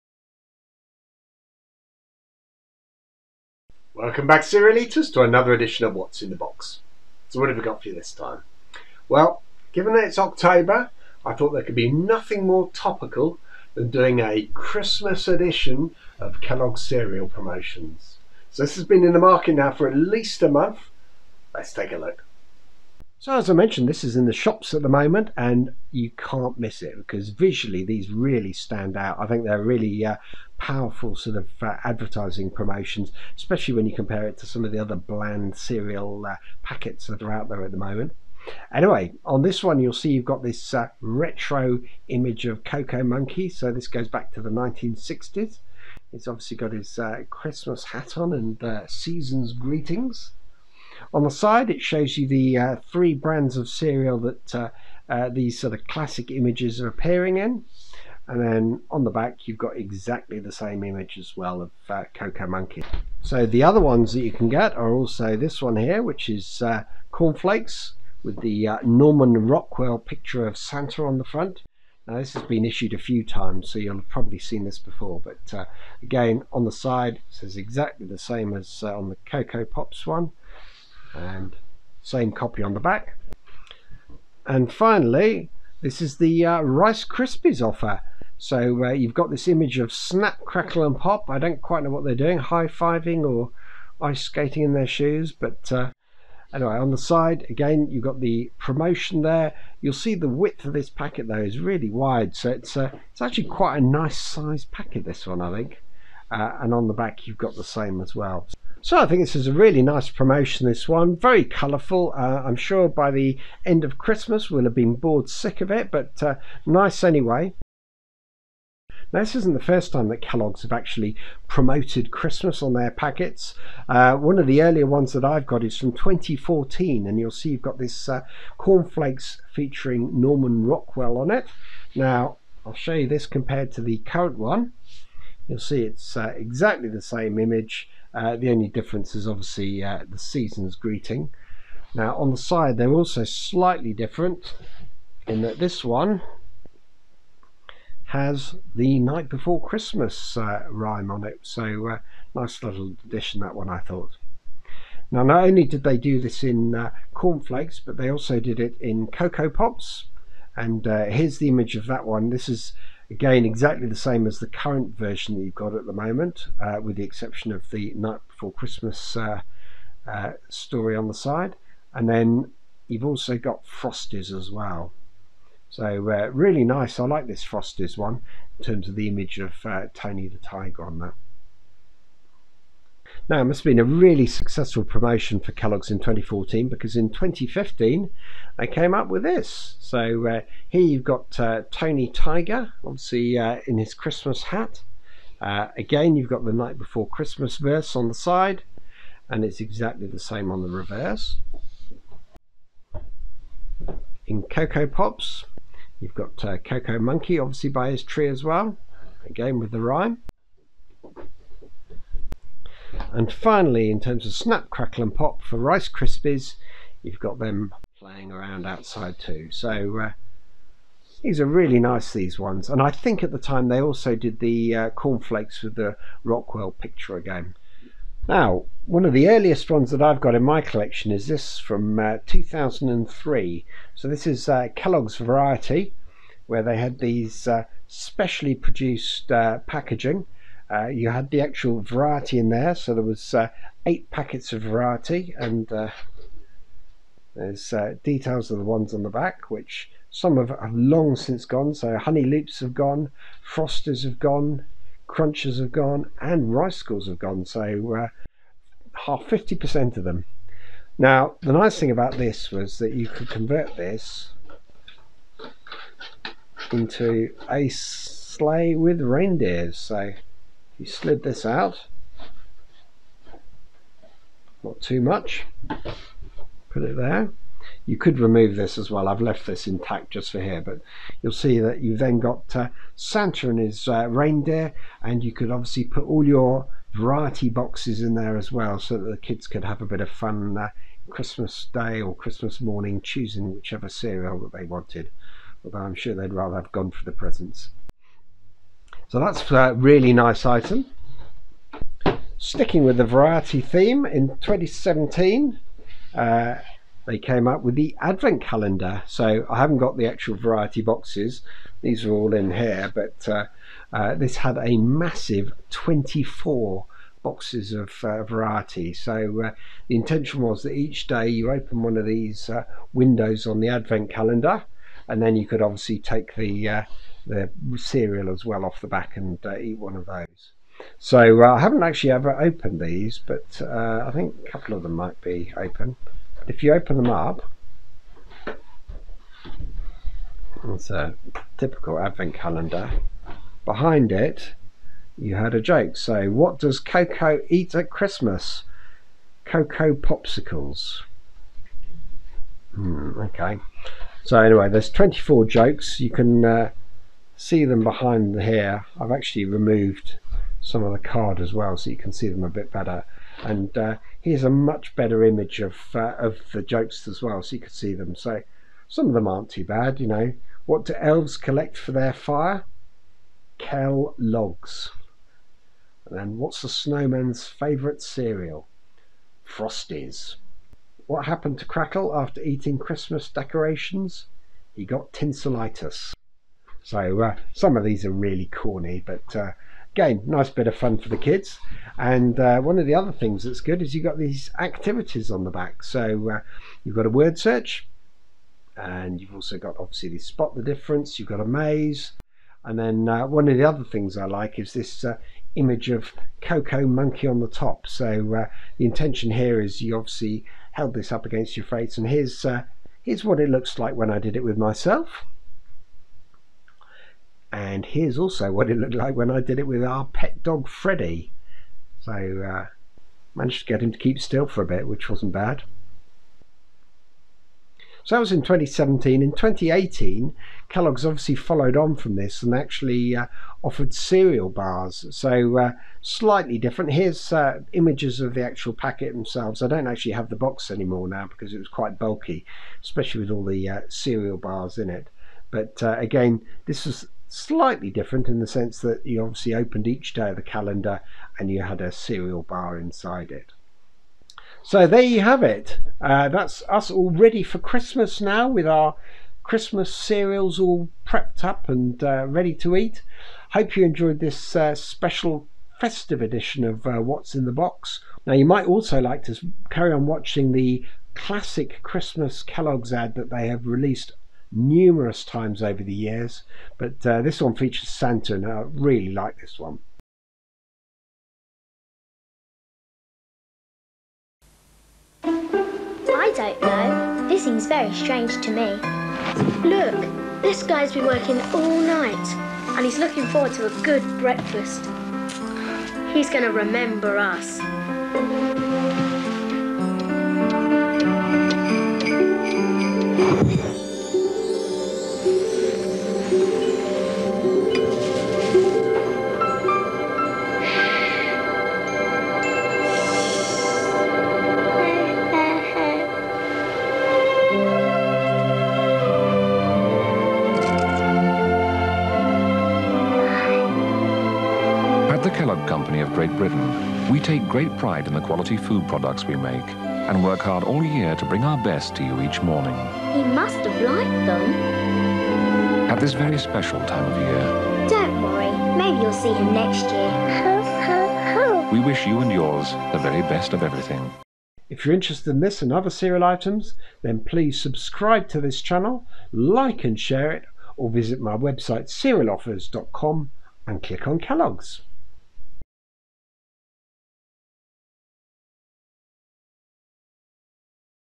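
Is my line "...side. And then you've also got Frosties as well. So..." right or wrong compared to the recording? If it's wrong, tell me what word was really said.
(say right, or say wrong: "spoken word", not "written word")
right.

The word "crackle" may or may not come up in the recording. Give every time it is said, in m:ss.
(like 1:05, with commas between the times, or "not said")
1:30, 3:34, 6:21.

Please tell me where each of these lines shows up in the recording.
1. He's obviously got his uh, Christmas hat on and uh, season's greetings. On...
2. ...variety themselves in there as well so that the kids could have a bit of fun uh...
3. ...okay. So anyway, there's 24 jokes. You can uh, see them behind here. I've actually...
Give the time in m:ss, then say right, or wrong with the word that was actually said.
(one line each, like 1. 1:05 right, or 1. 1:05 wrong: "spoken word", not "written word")
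1. 0:46 right
2. 4:46 wrong: "boxes", not "themselves"
3. 5:53 right.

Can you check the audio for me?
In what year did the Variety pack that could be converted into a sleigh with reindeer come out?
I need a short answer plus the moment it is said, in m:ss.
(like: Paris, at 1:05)
2003, at 3:52.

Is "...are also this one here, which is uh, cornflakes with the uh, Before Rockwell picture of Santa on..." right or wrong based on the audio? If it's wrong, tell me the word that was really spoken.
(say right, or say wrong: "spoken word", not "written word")
wrong: "Norman", not "Before".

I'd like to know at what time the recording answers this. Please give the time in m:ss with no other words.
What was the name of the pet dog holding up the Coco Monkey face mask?
7:00.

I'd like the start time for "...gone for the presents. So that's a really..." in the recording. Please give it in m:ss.
4:56.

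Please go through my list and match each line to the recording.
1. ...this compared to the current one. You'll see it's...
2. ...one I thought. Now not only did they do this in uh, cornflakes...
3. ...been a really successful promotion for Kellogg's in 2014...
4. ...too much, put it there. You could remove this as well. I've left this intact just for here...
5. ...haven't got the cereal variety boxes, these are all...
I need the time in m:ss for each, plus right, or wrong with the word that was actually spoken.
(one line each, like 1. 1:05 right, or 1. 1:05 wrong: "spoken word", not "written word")
1. 2:13 right
2. 2:33 right
3. 3:03 right
4. 4:34 right
5. 5:09 wrong: "actual", not "cereal".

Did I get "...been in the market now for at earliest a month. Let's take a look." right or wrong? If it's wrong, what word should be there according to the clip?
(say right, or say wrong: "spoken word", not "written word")
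wrong: "least", not "earliest".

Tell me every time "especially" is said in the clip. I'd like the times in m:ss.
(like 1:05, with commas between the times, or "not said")
0:33, 7:22.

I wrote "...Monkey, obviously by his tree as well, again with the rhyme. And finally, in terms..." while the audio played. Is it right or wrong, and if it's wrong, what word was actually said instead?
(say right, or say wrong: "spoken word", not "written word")
right.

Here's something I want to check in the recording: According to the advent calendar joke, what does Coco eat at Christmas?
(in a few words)
Coco popsicles.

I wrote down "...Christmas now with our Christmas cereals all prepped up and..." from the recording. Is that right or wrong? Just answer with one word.
right.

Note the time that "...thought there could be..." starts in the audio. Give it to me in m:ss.
0:11.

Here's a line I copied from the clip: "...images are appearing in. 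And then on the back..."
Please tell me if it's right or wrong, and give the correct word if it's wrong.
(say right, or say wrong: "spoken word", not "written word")
right.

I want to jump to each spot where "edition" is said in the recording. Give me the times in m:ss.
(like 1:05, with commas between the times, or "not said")
0:05, 0:15, 7:46.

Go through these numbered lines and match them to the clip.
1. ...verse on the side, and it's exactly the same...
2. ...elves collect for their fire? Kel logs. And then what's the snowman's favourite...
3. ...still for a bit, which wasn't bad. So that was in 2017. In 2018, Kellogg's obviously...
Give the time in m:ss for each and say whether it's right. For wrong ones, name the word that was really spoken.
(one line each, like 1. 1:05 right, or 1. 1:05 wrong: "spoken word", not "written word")
1. 3:17 right
2. 6:10 right
3. 7:04 right.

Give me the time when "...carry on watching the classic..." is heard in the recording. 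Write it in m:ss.
7:49.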